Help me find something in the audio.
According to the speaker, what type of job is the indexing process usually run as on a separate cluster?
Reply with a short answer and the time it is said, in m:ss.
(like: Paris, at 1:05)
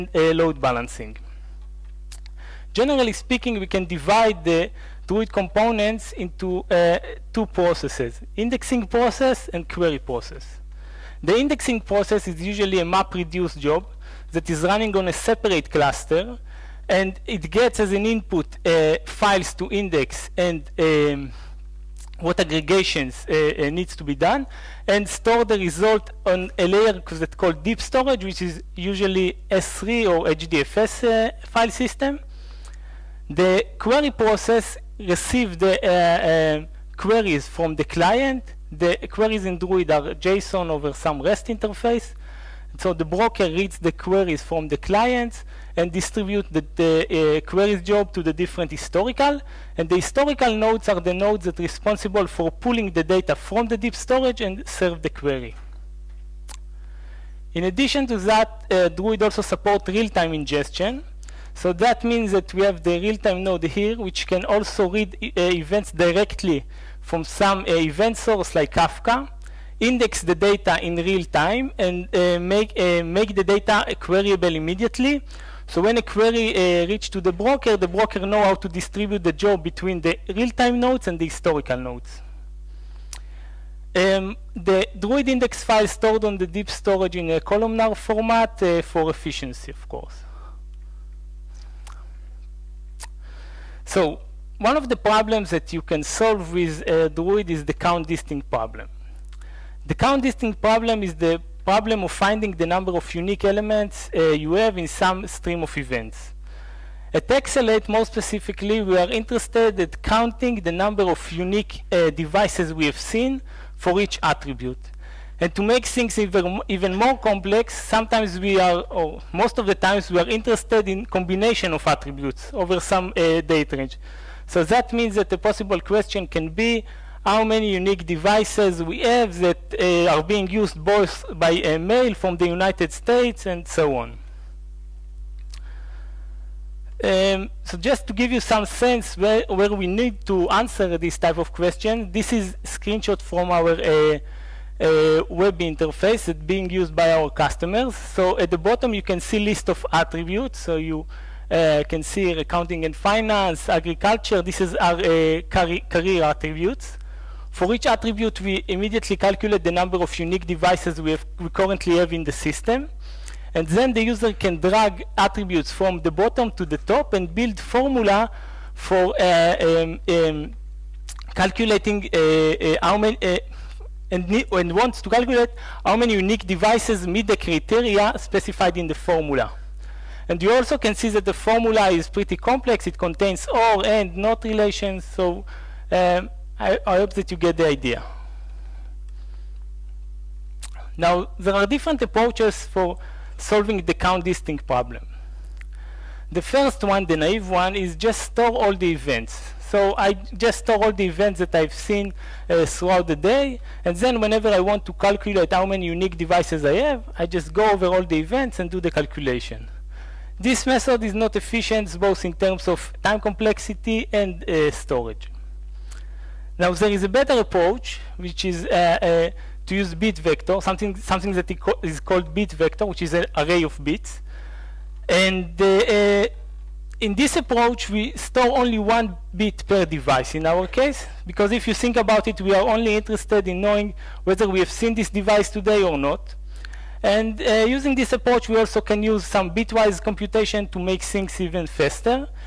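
map-reduce job, at 0:12.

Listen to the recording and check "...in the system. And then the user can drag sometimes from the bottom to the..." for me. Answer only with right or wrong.
wrong.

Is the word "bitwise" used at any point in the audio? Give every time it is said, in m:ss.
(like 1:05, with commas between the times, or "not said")
3:59.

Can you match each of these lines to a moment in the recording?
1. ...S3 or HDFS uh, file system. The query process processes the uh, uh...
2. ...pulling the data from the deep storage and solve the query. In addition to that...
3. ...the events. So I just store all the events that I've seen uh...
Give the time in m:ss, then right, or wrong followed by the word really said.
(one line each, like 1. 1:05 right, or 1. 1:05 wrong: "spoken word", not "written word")
1. 0:29 wrong: "receives", not "processes"
2. 0:52 wrong: "serve", not "solve"
3. 3:18 right.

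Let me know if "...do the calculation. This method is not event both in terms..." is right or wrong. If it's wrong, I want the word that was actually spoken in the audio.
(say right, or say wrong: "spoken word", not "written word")
wrong: "efficient", not "event".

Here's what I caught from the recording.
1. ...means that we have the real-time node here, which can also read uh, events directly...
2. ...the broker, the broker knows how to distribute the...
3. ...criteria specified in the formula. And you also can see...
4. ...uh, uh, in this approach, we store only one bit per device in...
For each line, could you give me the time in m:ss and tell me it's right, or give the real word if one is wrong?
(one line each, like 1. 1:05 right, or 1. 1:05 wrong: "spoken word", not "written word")
1. 1:02 right
2. 1:17 right
3. 2:57 right
4. 3:45 right.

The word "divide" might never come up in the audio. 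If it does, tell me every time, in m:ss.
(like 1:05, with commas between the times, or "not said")
0:03.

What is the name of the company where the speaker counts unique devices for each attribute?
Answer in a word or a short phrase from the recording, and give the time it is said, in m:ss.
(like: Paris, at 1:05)
eXelate, at 1:47.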